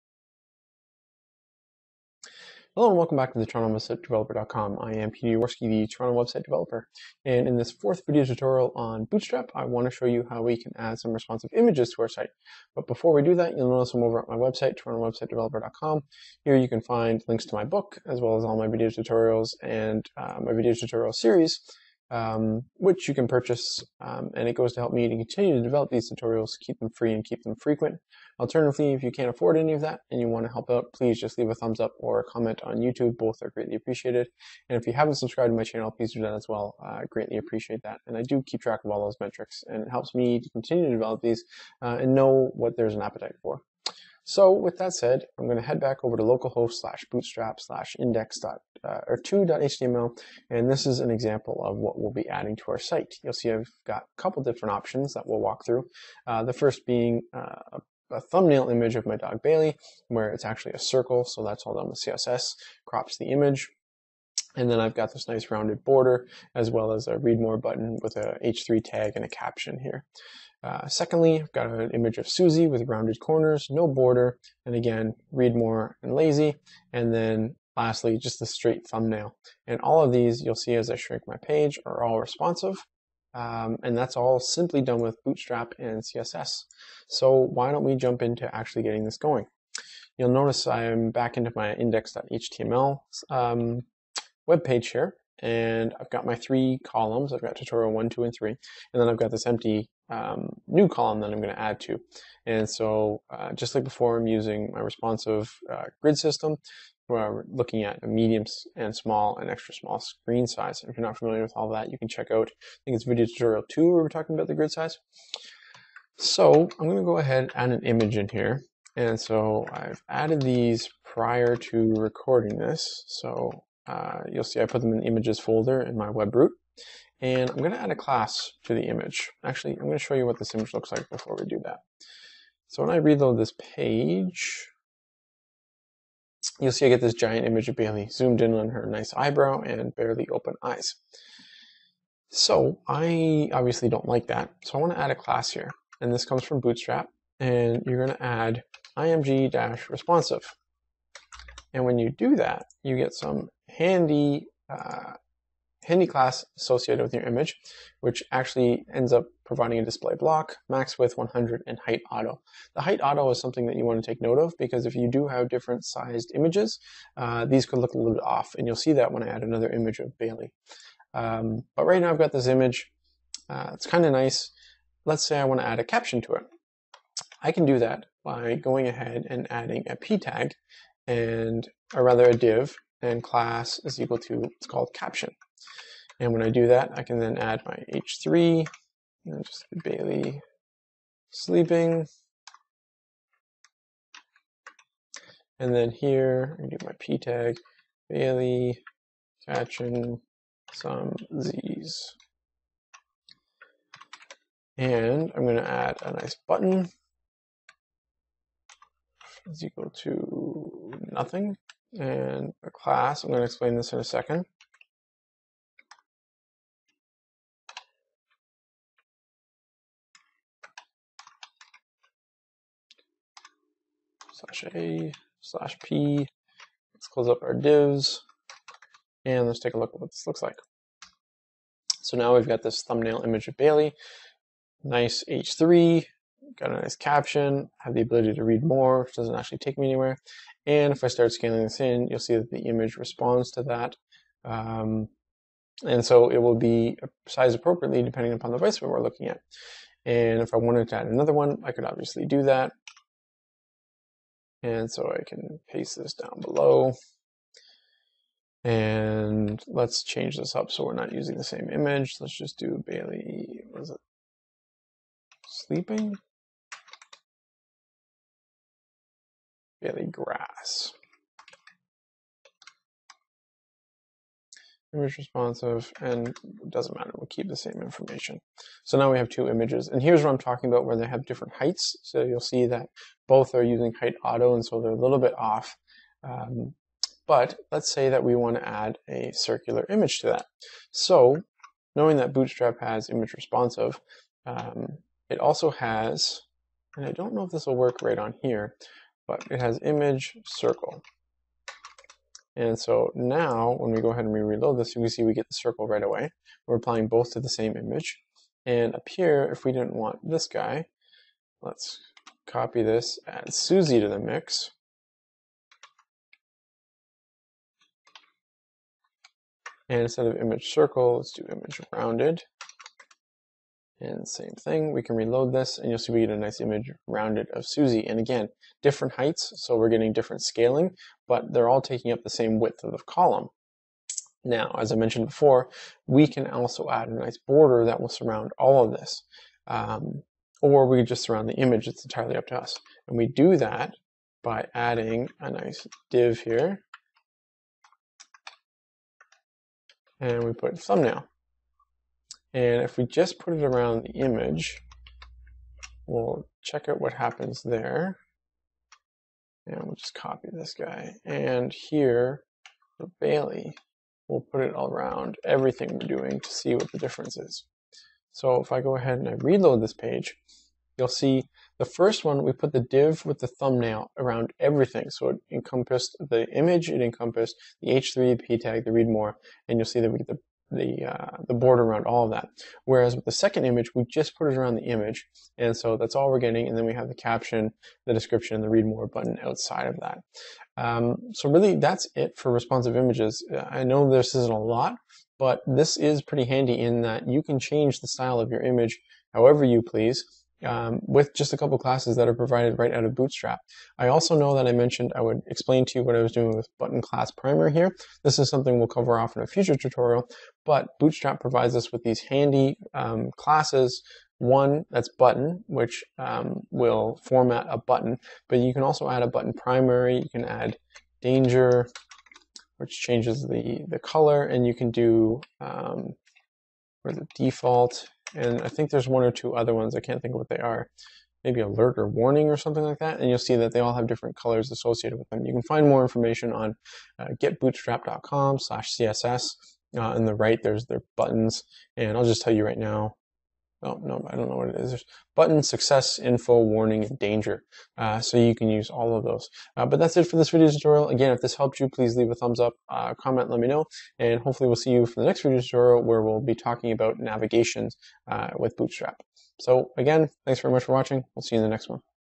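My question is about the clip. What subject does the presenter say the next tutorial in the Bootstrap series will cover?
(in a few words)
Navigations.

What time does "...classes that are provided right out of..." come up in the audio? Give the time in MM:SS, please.
06:41.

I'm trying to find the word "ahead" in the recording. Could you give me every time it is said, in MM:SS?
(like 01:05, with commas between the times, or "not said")
01:57, 02:58, 05:04, 06:08.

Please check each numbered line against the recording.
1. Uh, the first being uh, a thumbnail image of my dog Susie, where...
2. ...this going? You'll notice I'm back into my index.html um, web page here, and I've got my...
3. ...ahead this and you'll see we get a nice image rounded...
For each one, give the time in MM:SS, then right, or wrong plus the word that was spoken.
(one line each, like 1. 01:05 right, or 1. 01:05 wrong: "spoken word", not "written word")
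1. 00:56 wrong: "Bailey", not "Susie"
2. 01:29 right
3. 05:25 wrong: "reload", not "ahead".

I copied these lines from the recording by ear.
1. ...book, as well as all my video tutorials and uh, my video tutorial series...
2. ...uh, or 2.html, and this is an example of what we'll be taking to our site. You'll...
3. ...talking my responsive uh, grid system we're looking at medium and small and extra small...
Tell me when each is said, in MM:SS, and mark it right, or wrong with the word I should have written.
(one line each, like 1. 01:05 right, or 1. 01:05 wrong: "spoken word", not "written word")
1. 00:17 right
2. 00:48 wrong: "adding", not "taking"
3. 01:44 wrong: "using", not "talking".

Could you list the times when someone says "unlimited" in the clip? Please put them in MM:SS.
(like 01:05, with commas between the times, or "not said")
not said.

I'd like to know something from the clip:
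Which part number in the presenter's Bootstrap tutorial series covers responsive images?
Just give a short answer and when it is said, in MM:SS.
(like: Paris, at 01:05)
Fourth, at 00:07.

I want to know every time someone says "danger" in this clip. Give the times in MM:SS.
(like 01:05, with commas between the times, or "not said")
07:01, 07:27.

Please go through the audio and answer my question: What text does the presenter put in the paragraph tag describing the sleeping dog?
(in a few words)
Bailey catching some Z's.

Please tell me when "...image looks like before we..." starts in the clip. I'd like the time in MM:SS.
02:10.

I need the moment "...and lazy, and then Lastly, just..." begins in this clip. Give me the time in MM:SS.
01:16.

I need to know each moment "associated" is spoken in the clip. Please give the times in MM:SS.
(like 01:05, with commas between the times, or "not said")
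02:36, 07:14.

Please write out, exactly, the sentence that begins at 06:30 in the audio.
Um, so really, that's it for responsive images.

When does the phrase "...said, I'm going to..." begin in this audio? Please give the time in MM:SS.
00:44.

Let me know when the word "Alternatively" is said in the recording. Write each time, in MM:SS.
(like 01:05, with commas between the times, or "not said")
00:28.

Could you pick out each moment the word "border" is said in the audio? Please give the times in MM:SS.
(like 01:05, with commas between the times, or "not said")
01:05, 01:13, 05:37, 06:21.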